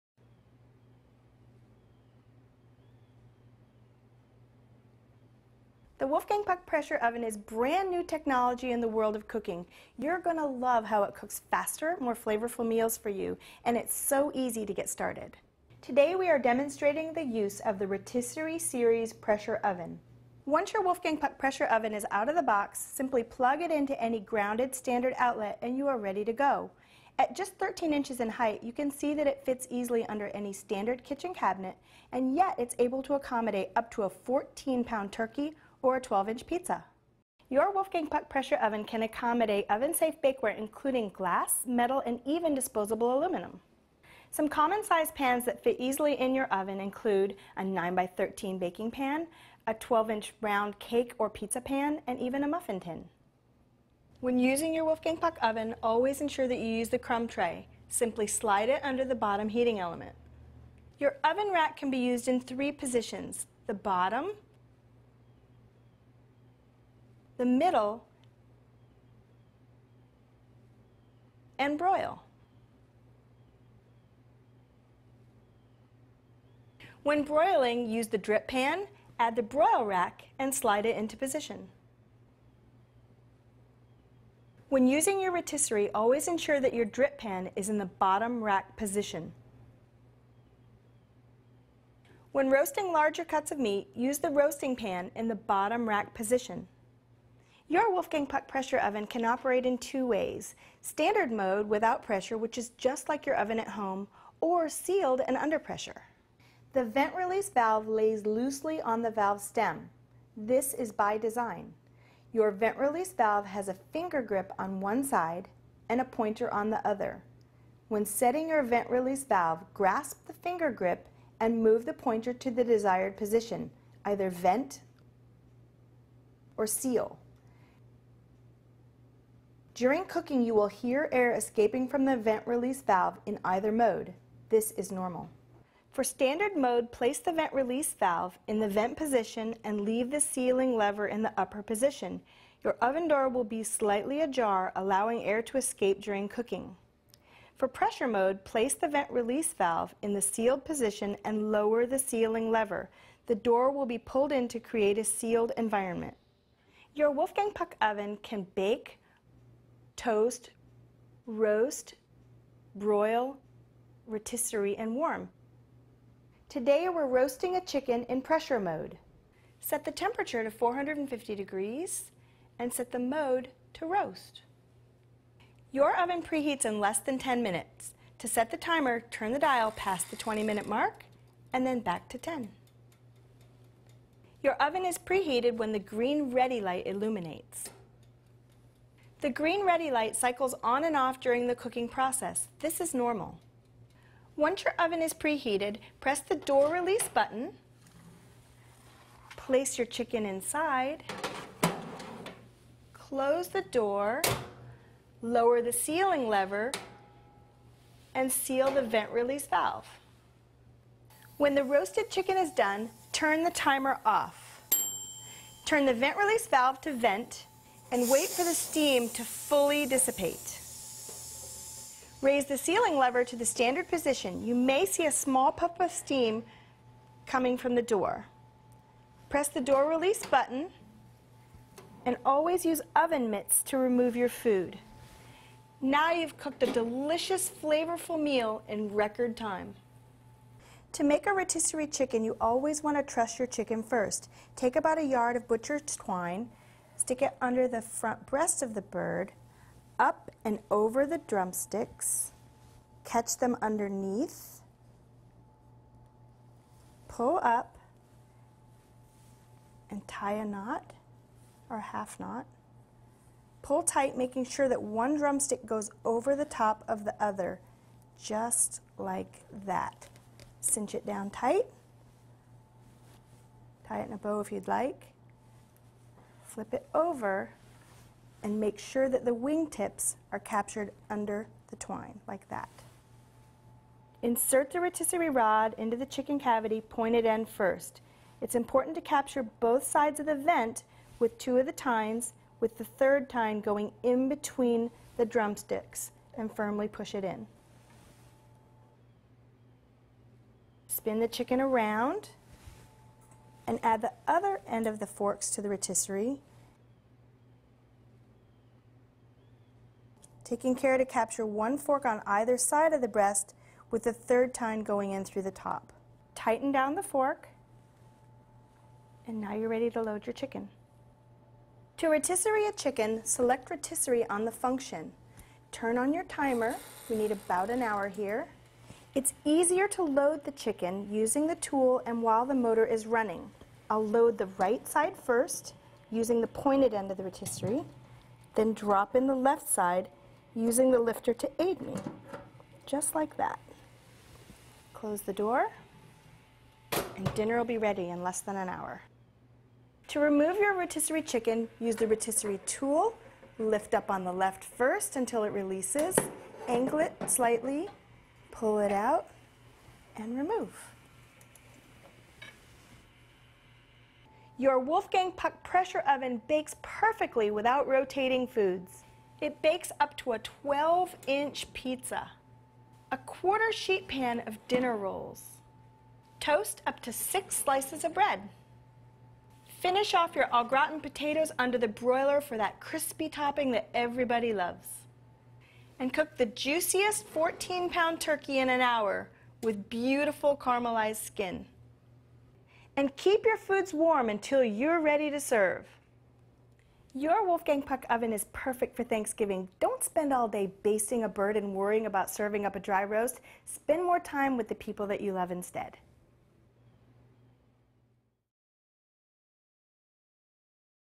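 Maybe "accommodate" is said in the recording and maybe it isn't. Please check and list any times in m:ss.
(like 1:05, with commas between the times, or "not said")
0:33, 0:39.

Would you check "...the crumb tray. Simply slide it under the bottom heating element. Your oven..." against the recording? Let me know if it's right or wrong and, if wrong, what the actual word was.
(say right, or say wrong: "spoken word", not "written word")
right.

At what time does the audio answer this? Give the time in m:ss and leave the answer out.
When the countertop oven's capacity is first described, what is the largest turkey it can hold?
0:34.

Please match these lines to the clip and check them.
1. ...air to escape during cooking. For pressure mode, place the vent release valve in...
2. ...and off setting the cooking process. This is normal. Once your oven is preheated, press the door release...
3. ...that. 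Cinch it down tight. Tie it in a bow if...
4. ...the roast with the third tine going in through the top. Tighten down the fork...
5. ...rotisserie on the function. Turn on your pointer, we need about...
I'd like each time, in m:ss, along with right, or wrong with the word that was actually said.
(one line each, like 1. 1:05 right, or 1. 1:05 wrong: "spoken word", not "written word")
1. 2:25 right
2. 3:10 wrong: "during", not "setting"
3. 4:29 right
4. 5:13 wrong: "breast", not "roast"
5. 5:23 wrong: "timer", not "pointer".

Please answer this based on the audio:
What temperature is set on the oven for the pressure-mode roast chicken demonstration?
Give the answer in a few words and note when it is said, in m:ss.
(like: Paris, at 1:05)
450 degrees, at 2:50.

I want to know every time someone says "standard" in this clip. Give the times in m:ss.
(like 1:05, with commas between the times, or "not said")
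0:24, 0:30, 1:40, 2:16, 3:43.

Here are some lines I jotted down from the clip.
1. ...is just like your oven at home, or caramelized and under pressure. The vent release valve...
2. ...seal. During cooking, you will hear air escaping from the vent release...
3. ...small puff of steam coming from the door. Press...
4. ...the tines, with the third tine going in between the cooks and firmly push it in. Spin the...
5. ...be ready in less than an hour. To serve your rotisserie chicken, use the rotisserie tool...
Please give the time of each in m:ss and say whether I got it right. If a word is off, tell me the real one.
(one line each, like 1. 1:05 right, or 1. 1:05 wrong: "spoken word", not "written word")
1. 1:42 wrong: "sealed", not "caramelized"
2. 2:06 right
3. 3:45 right
4. 4:51 wrong: "drumsticks", not "cooks"
5. 5:47 wrong: "remove", not "serve".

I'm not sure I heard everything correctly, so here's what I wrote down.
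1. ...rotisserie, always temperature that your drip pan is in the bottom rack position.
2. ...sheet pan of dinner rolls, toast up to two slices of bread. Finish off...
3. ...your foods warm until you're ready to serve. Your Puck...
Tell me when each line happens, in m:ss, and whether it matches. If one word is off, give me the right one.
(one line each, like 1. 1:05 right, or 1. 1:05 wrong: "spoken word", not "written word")
1. 1:25 wrong: "ensure", not "temperature"
2. 6:13 wrong: "six", not "two"
3. 6:33 wrong: "Wolfgang", not "Puck".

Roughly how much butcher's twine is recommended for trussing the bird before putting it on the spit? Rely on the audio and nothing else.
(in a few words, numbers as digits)
a yard.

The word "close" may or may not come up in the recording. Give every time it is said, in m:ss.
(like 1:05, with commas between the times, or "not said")
3:22, 5:44.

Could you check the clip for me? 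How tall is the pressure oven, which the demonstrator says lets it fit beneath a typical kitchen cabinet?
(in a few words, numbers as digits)
13 inches.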